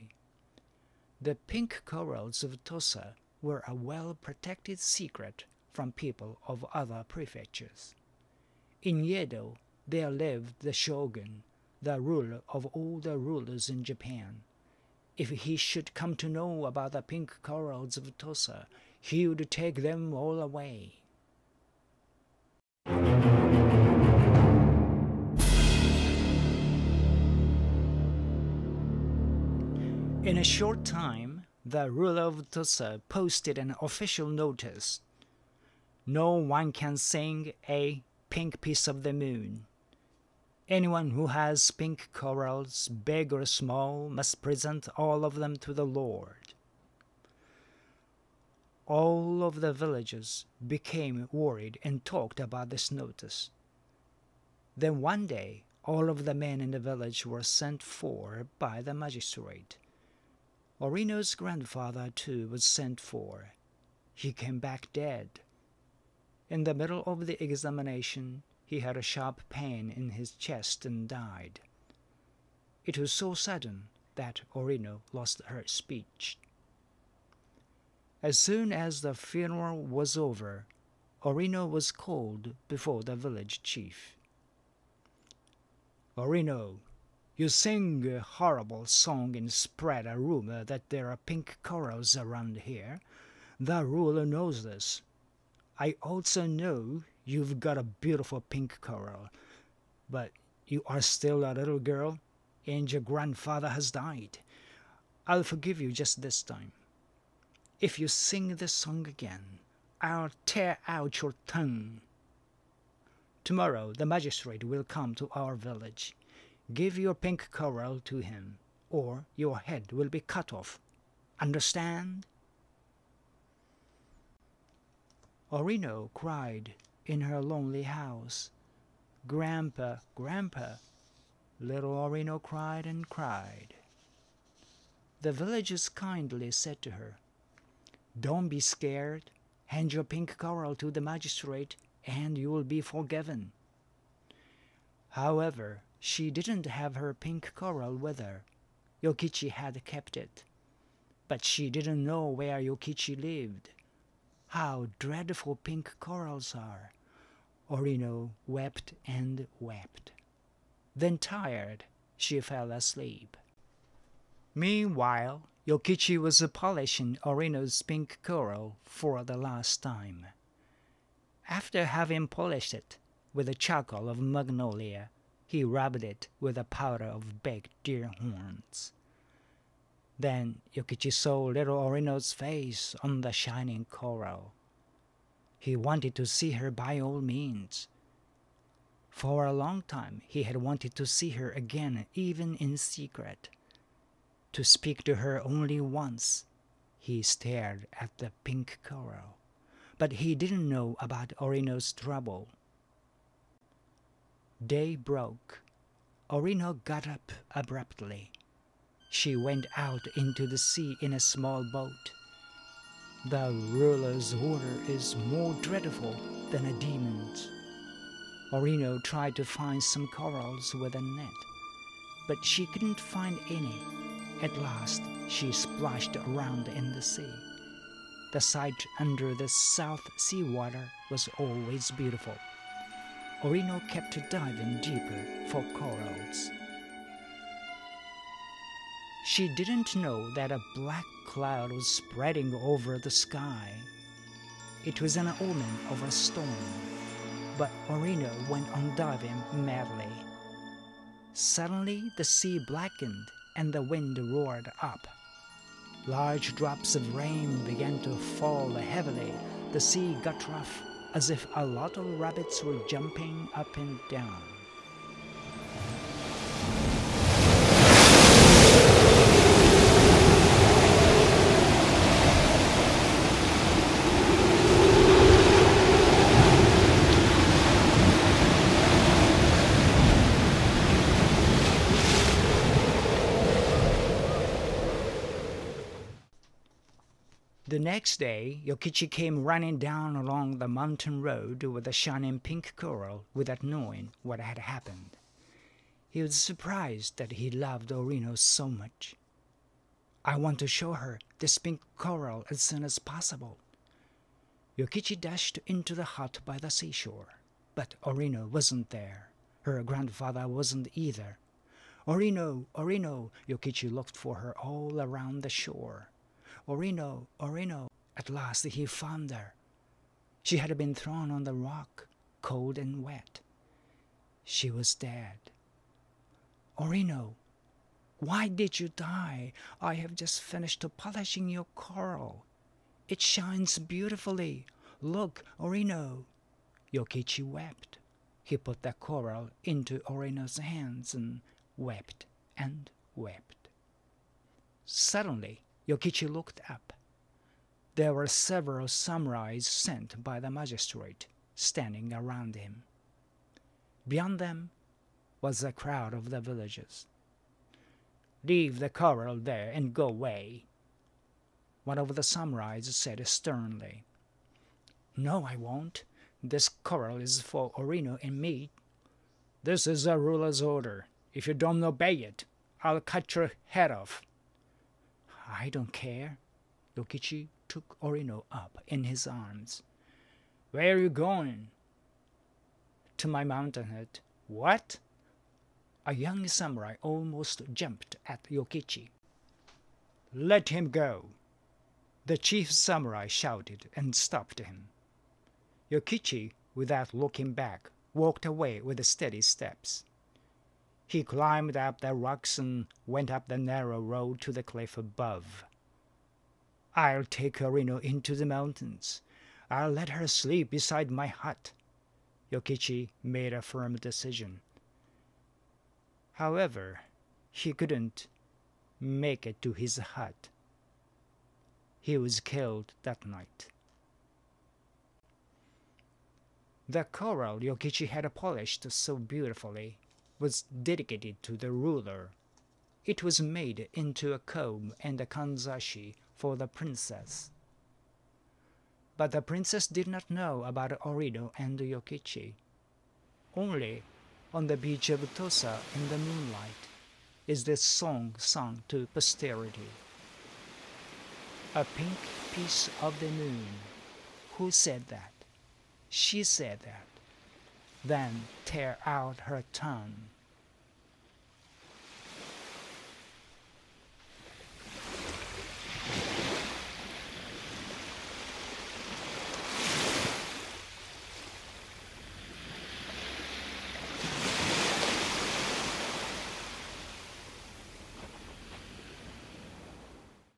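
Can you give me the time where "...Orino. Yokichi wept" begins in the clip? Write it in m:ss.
5:35.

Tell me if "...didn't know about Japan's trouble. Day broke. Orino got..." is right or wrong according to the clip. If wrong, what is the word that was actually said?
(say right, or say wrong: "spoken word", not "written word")
wrong: "Orino", not "Japan".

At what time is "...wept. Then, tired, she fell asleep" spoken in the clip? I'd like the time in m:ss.
2:39.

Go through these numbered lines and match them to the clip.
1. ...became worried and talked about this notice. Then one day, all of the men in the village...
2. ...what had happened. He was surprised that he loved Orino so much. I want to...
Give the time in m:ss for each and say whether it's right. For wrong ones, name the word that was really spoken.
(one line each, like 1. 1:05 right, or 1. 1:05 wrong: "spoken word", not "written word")
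1. 0:50 right
2. 4:54 right.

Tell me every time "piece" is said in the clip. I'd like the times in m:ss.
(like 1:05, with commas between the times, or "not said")
0:38, 7:32.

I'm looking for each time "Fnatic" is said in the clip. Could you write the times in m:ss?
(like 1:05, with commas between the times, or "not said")
not said.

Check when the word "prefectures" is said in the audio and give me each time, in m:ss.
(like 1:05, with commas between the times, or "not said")
0:07.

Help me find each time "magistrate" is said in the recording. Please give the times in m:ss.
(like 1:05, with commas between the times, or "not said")
0:58, 1:54, 2:21, 5:50.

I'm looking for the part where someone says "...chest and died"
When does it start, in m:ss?
1:10.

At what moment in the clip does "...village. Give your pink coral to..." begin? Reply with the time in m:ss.
1:55.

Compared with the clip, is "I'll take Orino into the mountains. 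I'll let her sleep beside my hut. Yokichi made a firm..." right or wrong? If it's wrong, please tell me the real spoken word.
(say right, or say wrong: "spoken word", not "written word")
right.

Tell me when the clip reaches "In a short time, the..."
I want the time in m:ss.
0:30.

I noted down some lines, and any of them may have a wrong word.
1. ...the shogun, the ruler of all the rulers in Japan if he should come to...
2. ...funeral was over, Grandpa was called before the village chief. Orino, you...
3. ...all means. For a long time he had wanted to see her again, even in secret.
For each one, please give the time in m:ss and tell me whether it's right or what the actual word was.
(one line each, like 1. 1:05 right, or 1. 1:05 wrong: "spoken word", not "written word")
1. 0:10 right
2. 1:19 wrong: "Orino", not "Grandpa"
3. 3:07 right.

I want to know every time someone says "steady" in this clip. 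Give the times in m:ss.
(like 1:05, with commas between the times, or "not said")
6:39.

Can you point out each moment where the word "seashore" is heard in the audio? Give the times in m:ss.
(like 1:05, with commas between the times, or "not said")
5:06.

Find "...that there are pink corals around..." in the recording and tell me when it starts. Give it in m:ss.
1:30.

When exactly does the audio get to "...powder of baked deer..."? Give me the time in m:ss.
2:56.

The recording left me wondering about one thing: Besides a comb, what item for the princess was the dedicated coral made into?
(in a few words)
A kanzashi.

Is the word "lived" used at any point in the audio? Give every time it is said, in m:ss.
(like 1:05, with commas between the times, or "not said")
0:10, 2:33.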